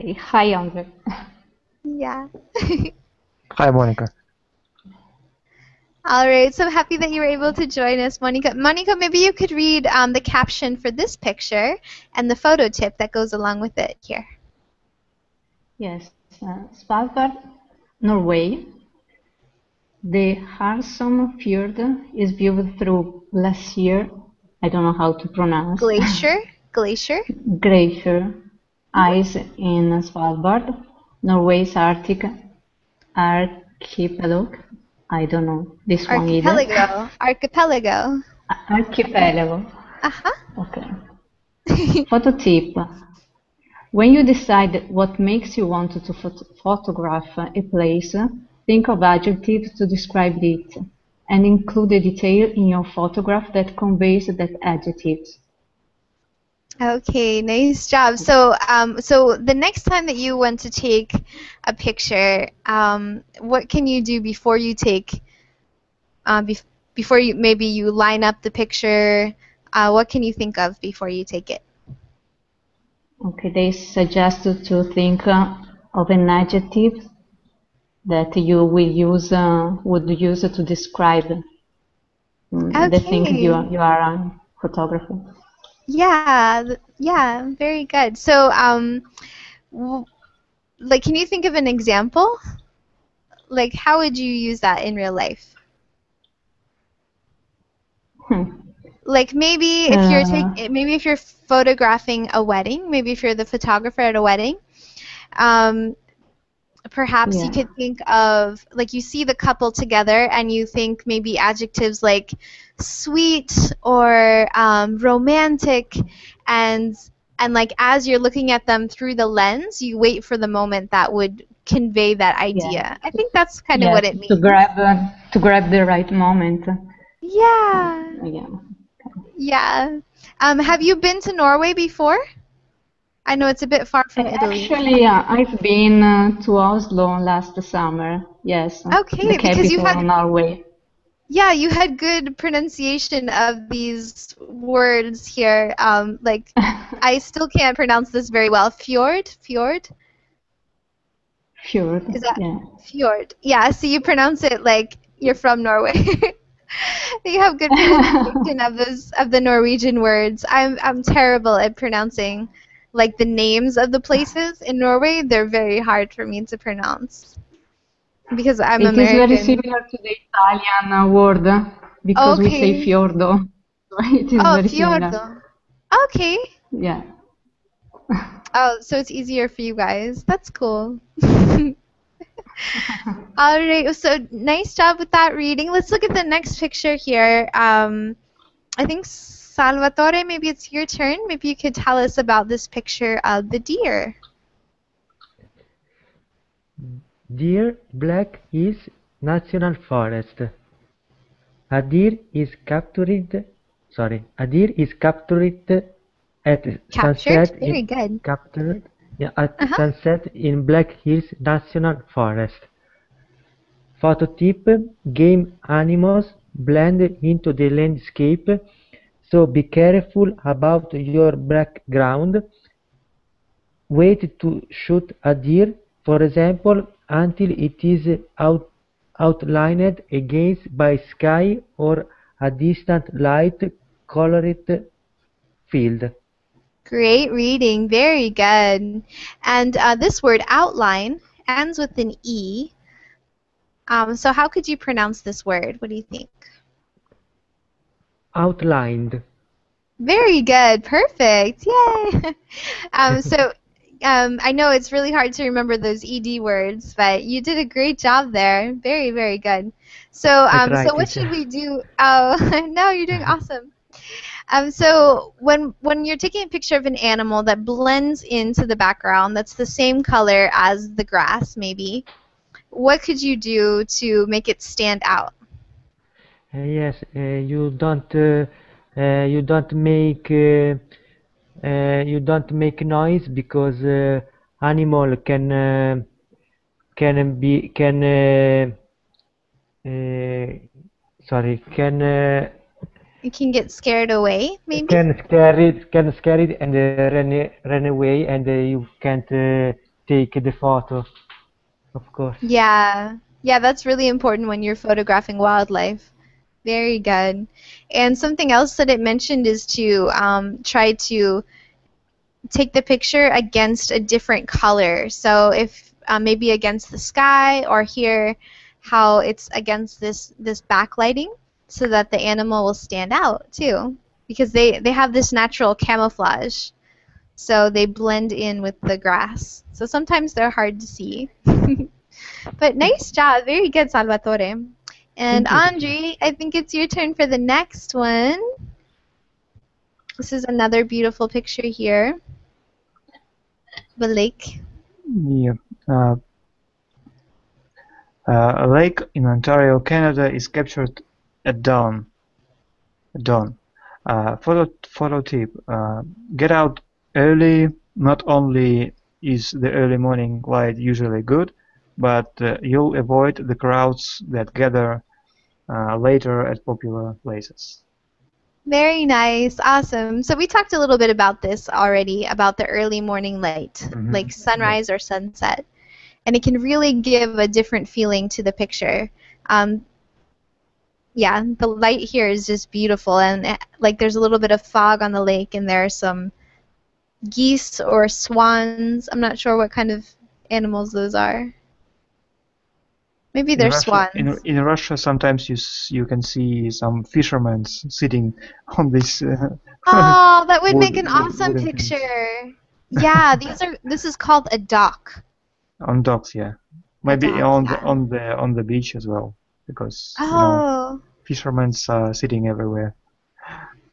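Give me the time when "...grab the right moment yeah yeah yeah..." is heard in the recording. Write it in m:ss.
2:05.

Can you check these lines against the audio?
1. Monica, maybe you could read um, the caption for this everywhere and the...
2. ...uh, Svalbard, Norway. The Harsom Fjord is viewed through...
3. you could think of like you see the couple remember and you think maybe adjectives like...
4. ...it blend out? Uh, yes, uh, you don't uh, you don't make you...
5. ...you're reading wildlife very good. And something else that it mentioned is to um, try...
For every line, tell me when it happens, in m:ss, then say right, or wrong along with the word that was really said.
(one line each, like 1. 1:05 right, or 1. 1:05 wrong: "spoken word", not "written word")
1. 0:08 wrong: "picture", not "everywhere"
2. 0:16 right
3. 1:47 wrong: "together", not "remember"
4. 4:34 wrong: "stand", not "blend"
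5. 5:04 wrong: "photographing", not "reading".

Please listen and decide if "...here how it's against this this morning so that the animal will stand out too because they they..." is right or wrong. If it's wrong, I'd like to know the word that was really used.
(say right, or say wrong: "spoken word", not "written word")
wrong: "backlighting", not "morning".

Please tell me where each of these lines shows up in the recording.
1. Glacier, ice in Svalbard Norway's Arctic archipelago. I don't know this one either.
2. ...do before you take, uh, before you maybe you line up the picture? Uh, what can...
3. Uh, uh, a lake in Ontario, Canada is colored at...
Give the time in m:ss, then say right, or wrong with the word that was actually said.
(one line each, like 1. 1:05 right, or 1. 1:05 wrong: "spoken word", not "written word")
1. 0:27 right
2. 1:04 right
3. 5:45 wrong: "captured", not "colored".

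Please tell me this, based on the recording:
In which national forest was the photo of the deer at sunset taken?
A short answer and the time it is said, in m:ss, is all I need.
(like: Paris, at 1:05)
Black Hills National Forest, at 3:30.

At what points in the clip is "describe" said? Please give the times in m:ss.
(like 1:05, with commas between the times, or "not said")
0:49, 1:20.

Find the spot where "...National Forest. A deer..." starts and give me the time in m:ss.
3:19.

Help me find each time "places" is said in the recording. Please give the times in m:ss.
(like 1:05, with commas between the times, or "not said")
0:47, 2:44, 6:07.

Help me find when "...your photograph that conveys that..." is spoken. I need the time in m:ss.
0:52.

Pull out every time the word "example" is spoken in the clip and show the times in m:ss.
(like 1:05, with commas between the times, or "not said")
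1:31, 3:46.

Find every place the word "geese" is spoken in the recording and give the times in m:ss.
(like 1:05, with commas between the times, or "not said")
6:27.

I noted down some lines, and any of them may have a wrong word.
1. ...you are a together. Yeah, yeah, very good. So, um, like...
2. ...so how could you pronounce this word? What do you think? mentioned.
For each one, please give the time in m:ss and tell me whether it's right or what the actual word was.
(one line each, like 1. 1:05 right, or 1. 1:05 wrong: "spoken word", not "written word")
1. 1:23 wrong: "photographer", not "together"
2. 4:04 wrong: "outlined", not "mentioned".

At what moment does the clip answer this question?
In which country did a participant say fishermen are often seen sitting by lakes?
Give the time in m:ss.
6:34.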